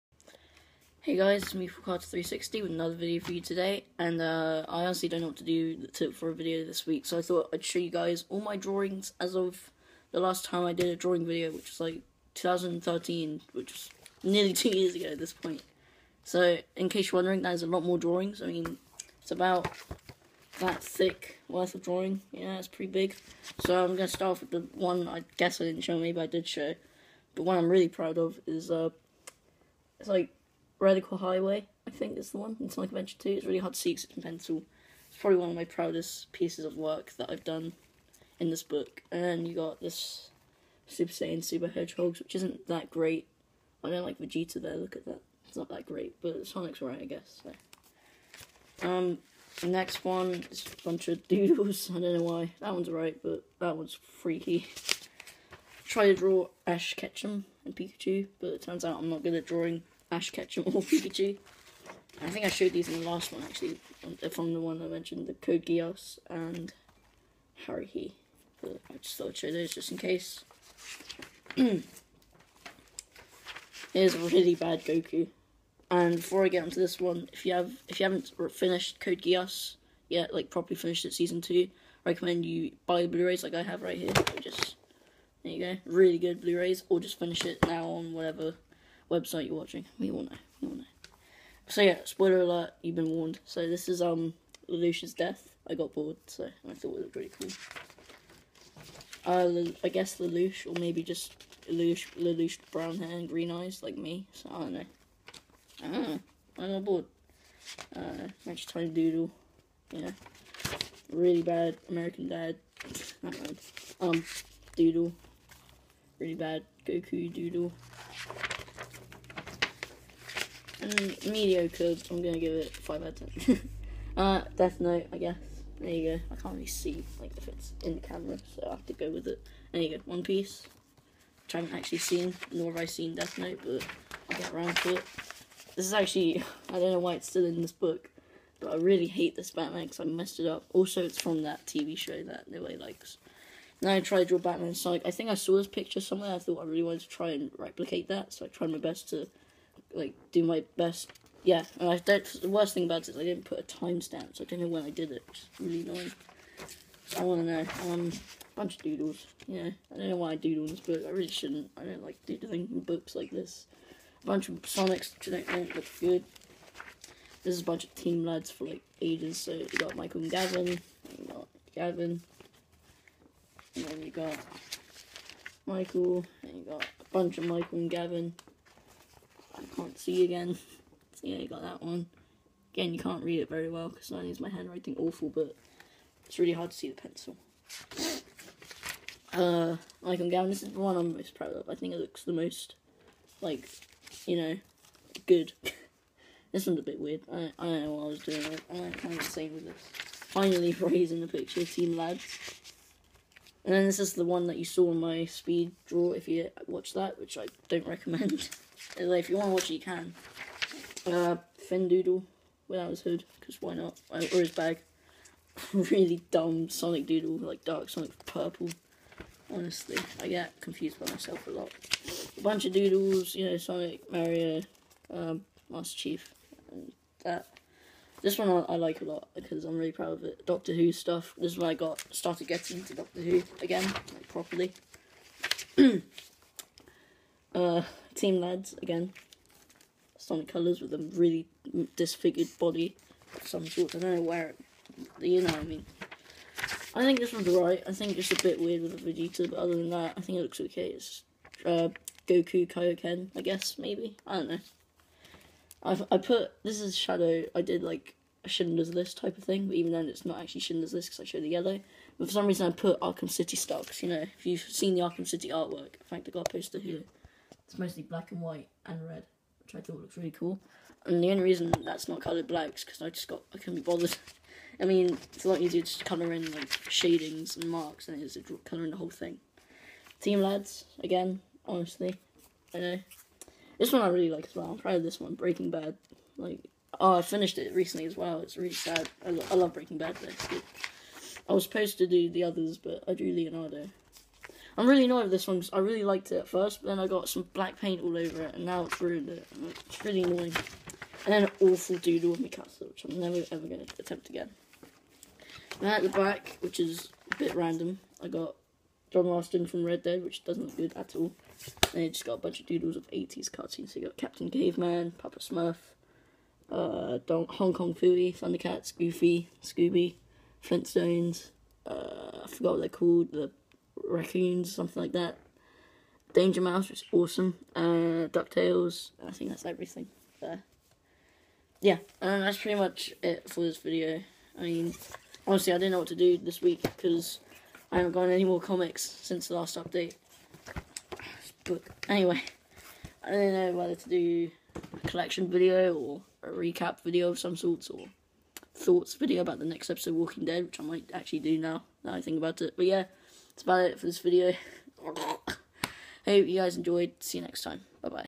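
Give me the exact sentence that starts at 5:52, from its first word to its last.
But yeah that's about it for this video.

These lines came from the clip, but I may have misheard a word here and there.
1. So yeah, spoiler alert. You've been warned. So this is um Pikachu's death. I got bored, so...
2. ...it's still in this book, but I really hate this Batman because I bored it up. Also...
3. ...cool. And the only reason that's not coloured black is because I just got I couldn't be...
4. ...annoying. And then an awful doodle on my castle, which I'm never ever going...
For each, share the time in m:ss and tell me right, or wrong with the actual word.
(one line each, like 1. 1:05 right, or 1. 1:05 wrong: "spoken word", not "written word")
1. 1:31 wrong: "Lelouch", not "Pikachu"
2. 2:17 wrong: "messed", not "bored"
3. 4:30 right
4. 5:00 right.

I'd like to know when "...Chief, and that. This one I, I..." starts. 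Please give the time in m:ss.
3:45.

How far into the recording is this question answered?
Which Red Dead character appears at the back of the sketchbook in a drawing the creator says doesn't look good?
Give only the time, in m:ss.
5:09.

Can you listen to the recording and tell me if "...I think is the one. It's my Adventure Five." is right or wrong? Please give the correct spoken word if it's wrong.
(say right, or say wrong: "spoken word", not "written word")
wrong: "Two", not "Five".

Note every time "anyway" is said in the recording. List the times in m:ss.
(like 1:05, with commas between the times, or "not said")
3:28, 5:42.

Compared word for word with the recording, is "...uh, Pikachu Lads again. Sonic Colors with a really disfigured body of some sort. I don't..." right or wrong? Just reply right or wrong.
wrong.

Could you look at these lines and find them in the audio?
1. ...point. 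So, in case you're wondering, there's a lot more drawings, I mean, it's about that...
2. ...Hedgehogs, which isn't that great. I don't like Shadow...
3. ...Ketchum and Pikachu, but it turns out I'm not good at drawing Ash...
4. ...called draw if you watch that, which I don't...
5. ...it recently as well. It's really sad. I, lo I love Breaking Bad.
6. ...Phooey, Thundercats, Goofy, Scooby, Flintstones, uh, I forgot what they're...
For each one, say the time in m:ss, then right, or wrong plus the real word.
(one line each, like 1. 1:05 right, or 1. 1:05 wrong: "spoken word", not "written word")
1. 0:15 right
2. 0:41 wrong: "Vegeta", not "Shadow"
3. 0:56 right
4. 3:25 wrong: "speed", not "called"
5. 4:47 right
6. 5:17 right.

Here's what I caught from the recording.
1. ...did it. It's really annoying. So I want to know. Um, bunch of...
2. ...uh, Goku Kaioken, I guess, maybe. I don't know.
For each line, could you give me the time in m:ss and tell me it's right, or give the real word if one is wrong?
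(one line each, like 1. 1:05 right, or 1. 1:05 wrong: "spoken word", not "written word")
1. 2:34 right
2. 4:11 right.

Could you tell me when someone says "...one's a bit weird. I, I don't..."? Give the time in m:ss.
3:16.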